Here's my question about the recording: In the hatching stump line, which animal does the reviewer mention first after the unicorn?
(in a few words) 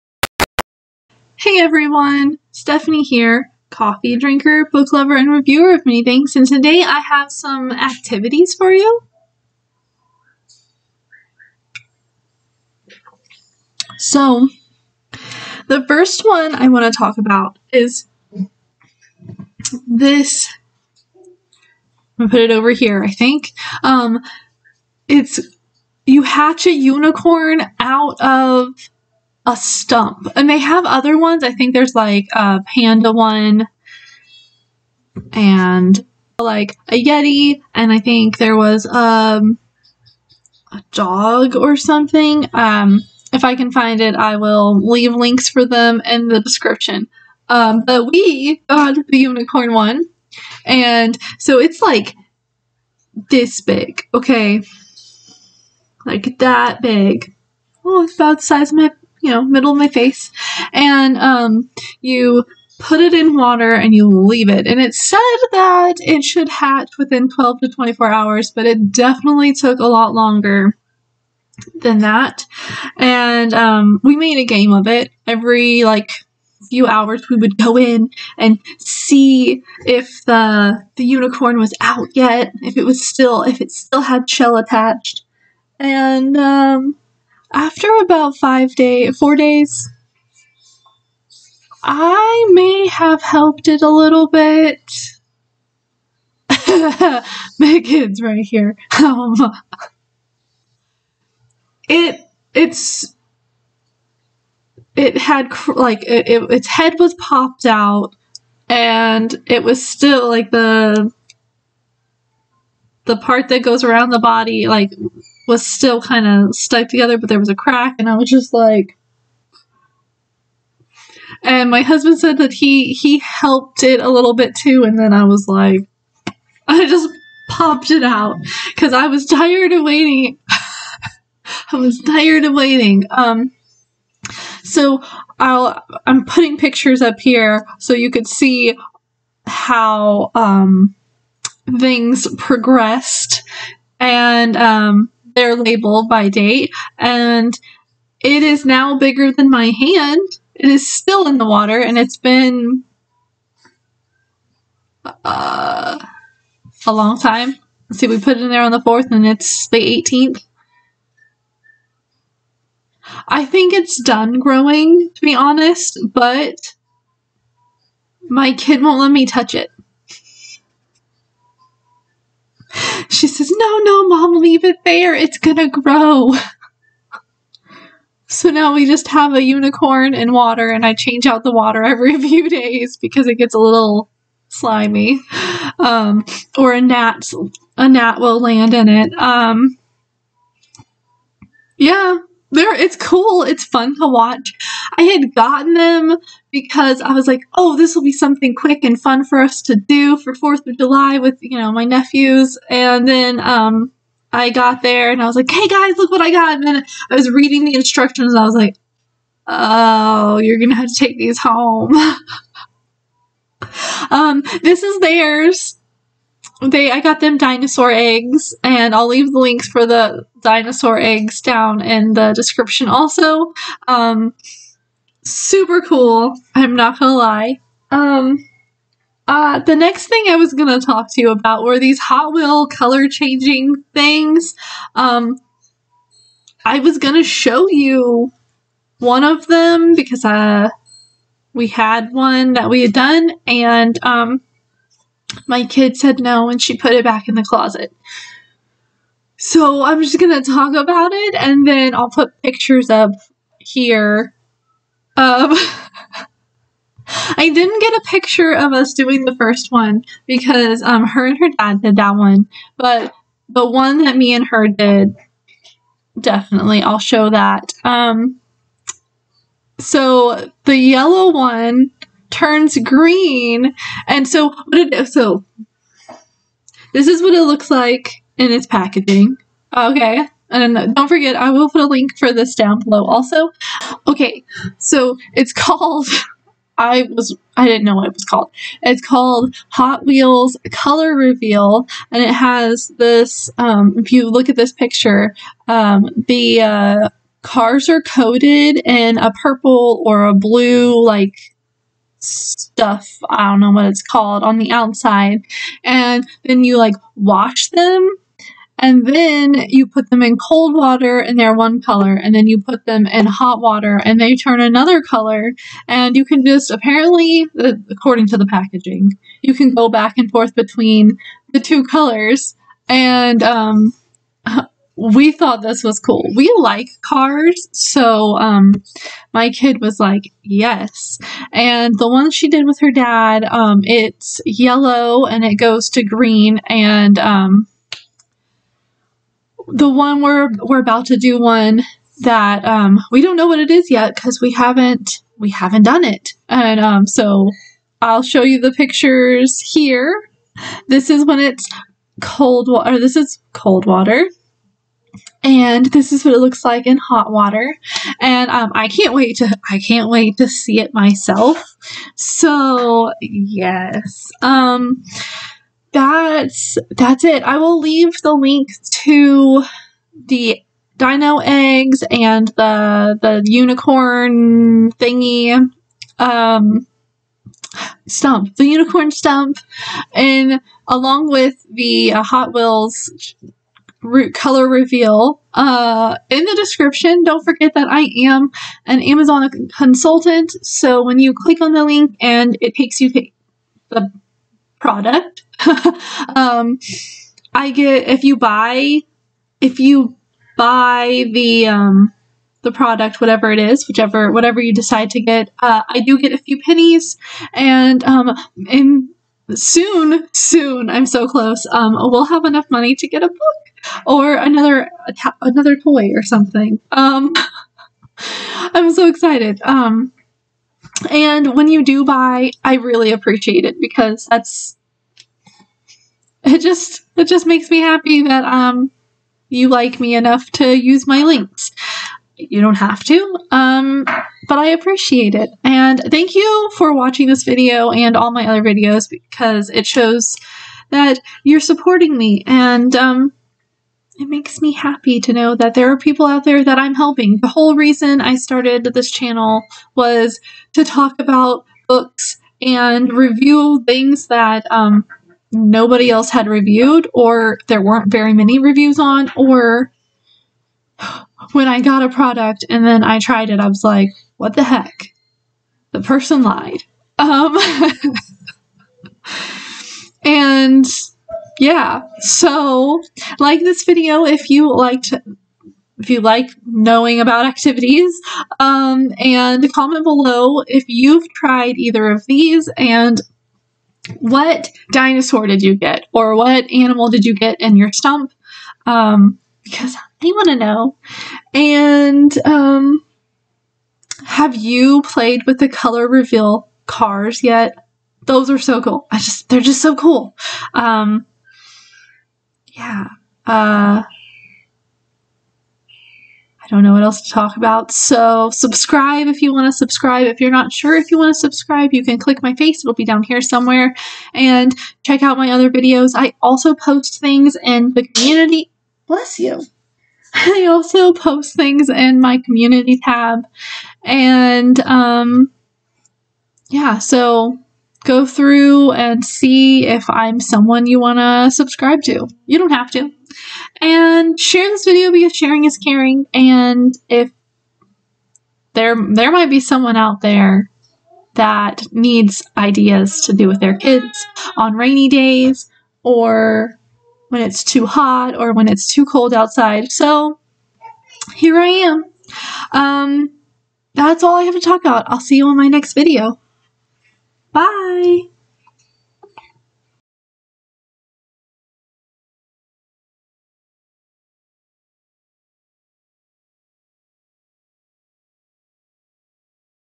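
panda.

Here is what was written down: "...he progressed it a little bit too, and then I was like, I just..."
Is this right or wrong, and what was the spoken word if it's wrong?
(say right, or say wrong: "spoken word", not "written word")
wrong: "helped", not "progressed".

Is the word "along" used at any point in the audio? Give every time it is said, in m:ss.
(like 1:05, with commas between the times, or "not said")
6:20.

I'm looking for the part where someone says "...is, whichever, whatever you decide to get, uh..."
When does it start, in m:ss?
6:43.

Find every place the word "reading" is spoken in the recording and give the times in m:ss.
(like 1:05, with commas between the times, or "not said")
3:27.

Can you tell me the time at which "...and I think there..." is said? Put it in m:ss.
0:37.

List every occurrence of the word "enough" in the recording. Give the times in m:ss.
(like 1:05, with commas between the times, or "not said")
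6:52, 7:10.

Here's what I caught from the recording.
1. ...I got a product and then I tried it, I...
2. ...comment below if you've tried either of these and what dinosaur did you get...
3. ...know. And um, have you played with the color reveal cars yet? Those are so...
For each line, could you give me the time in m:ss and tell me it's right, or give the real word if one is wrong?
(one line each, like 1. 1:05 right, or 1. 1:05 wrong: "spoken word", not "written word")
1. 7:41 right
2. 7:59 right
3. 8:10 right.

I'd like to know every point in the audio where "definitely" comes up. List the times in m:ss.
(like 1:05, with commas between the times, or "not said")
1:08, 4:26.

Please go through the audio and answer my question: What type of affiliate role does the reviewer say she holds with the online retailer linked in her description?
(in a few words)
Amazon consultant.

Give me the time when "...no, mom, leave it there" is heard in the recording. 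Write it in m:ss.
2:53.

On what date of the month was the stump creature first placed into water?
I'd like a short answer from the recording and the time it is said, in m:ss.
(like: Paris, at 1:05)
4th, at 2:38.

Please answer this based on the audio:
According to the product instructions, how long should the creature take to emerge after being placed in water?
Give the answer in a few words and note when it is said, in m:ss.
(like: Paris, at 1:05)
12 to 24 hours, at 1:07.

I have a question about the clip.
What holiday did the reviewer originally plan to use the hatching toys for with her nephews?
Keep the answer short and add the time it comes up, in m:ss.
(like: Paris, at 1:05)
Fourth of July, at 3:20.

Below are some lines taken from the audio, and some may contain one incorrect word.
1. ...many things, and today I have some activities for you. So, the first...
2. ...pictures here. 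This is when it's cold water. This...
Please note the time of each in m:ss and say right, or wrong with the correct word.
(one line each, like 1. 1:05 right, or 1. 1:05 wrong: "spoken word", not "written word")
1. 0:05 right
2. 5:48 right.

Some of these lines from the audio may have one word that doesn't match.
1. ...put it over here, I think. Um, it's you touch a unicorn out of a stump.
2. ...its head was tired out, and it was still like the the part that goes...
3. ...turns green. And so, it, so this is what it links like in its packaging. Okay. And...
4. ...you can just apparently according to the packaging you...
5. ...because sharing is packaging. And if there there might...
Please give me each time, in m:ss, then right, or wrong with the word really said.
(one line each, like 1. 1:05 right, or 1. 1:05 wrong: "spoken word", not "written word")
1. 0:22 wrong: "hatch", not "touch"
2. 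1:46 wrong: "popped", not "tired"
3. 4:32 wrong: "looks", not "links"
4. 5:16 right
5. 8:55 wrong: "caring", not "packaging".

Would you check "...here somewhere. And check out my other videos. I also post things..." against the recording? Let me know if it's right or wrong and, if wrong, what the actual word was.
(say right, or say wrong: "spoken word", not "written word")
right.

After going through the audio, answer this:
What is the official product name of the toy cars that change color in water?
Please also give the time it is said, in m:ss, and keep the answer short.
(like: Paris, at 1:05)
Hot Wheels Color Reveal, at 4:49.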